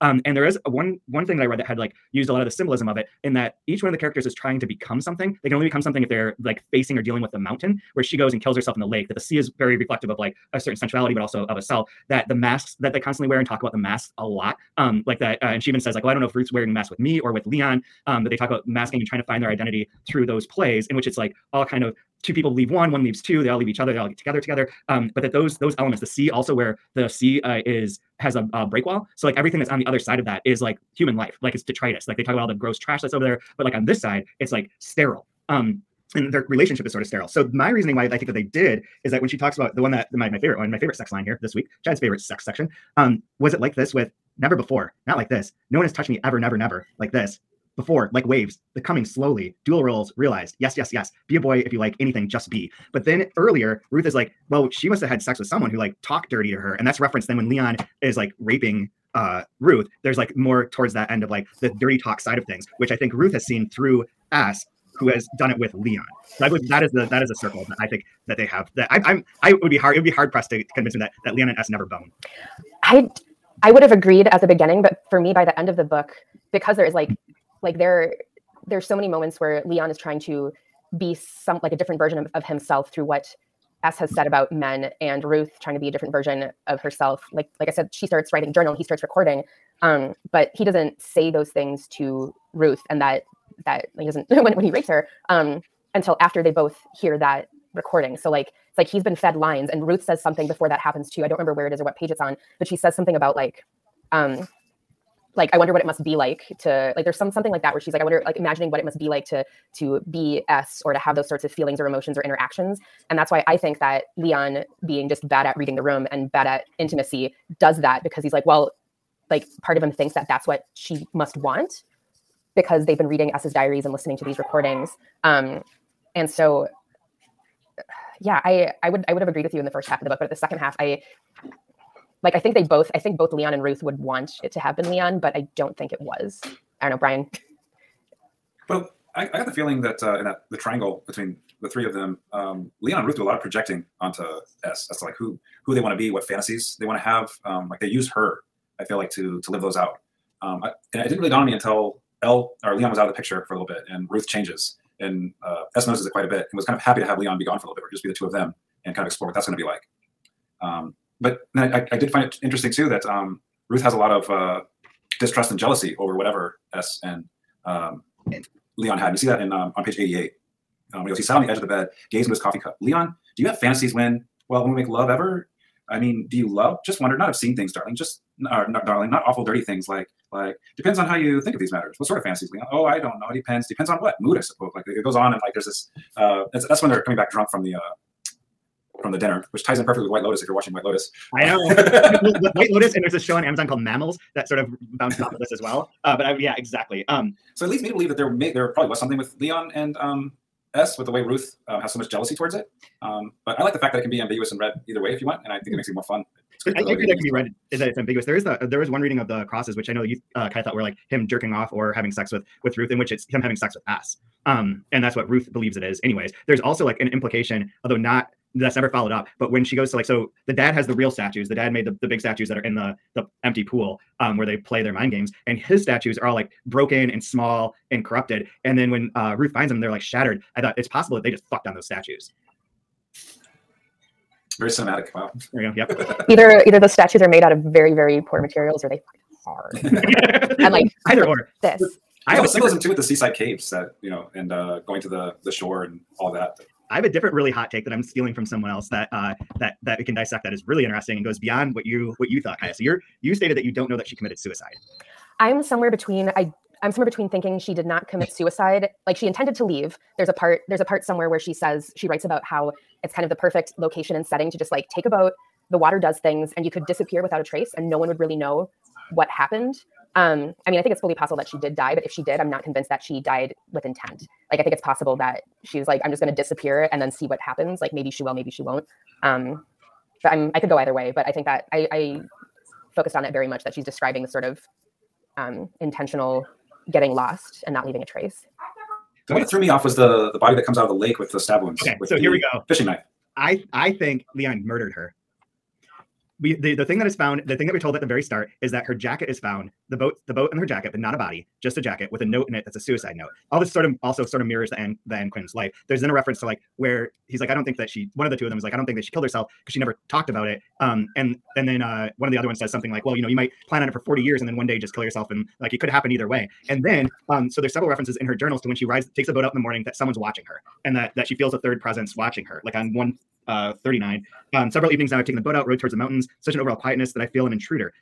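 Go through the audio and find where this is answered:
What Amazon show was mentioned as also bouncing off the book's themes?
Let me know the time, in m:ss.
3:13.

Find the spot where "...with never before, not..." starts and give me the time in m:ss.
0:43.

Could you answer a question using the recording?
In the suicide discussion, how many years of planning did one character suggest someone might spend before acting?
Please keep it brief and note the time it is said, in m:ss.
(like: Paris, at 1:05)
40, at 5:13.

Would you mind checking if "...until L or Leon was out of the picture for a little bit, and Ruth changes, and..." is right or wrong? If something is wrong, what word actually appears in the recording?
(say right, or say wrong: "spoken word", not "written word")
right.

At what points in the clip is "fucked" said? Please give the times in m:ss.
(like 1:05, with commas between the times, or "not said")
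3:51, 3:59.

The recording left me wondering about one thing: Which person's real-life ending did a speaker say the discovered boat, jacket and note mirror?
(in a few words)
Ann Quin.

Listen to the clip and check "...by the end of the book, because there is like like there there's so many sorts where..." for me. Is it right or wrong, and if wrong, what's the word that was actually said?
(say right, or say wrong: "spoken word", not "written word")
wrong: "moments", not "sorts".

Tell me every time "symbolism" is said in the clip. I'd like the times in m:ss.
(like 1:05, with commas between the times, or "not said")
0:02, 4:02.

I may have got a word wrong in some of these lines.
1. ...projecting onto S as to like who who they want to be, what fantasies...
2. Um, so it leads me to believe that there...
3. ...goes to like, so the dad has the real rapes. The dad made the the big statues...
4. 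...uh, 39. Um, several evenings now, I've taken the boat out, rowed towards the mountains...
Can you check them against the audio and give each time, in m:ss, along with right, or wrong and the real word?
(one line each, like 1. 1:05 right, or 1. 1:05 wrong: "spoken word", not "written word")
1. 2:23 right
2. 3:17 right
3. 3:39 wrong: "statues", not "rapes"
4. 5:23 right.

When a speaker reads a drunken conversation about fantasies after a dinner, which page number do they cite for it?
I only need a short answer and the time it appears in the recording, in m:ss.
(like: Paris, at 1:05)
88, at 2:49.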